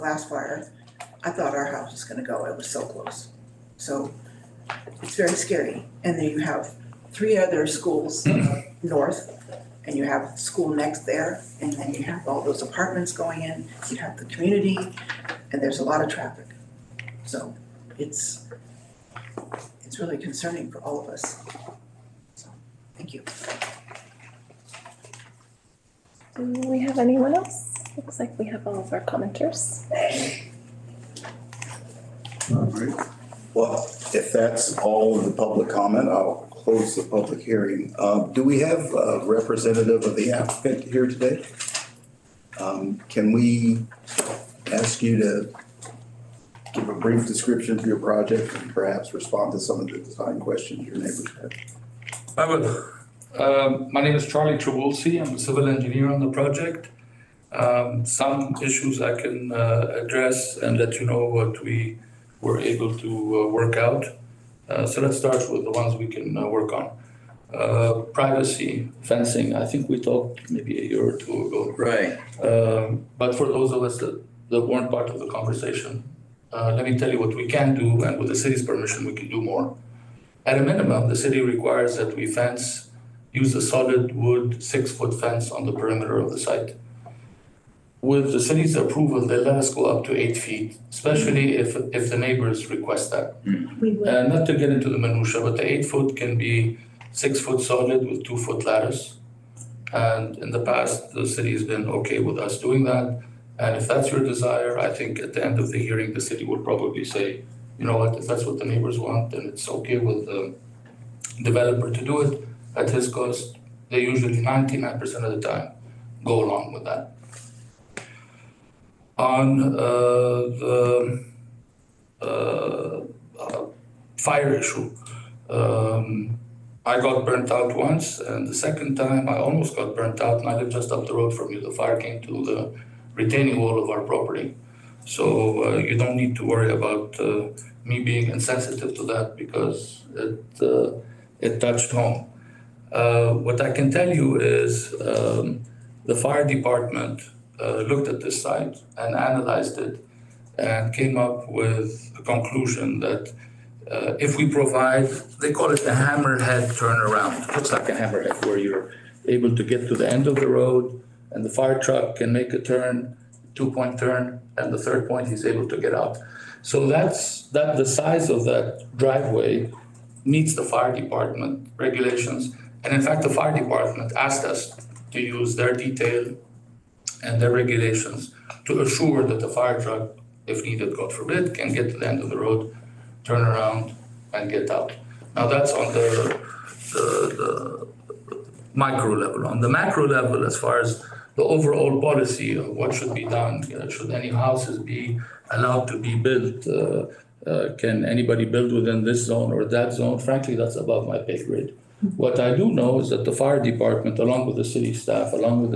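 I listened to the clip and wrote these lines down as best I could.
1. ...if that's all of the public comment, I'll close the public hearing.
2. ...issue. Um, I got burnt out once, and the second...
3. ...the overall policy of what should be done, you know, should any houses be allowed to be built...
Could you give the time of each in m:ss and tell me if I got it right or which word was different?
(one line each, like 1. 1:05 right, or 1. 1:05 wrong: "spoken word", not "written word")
1. 0:34 right
2. 2:04 right
3. 3:11 right.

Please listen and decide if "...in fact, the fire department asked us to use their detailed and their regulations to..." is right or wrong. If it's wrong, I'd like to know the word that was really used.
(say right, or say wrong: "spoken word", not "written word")
right.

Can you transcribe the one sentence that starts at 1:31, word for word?
if, if the neighbors request that.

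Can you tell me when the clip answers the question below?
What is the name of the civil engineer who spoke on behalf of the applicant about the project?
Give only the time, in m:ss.
0:54.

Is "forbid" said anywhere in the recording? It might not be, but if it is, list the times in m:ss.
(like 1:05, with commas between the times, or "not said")
3:01.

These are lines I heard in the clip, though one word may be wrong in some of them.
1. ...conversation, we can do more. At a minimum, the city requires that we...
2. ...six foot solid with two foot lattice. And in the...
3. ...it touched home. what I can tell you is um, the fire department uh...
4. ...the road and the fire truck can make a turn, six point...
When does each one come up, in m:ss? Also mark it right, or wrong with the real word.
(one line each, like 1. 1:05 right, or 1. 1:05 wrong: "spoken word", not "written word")
1. 1:18 wrong: "permission", not "conversation"
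2. 1:37 right
3. 2:21 right
4. 2:40 wrong: "two", not "six".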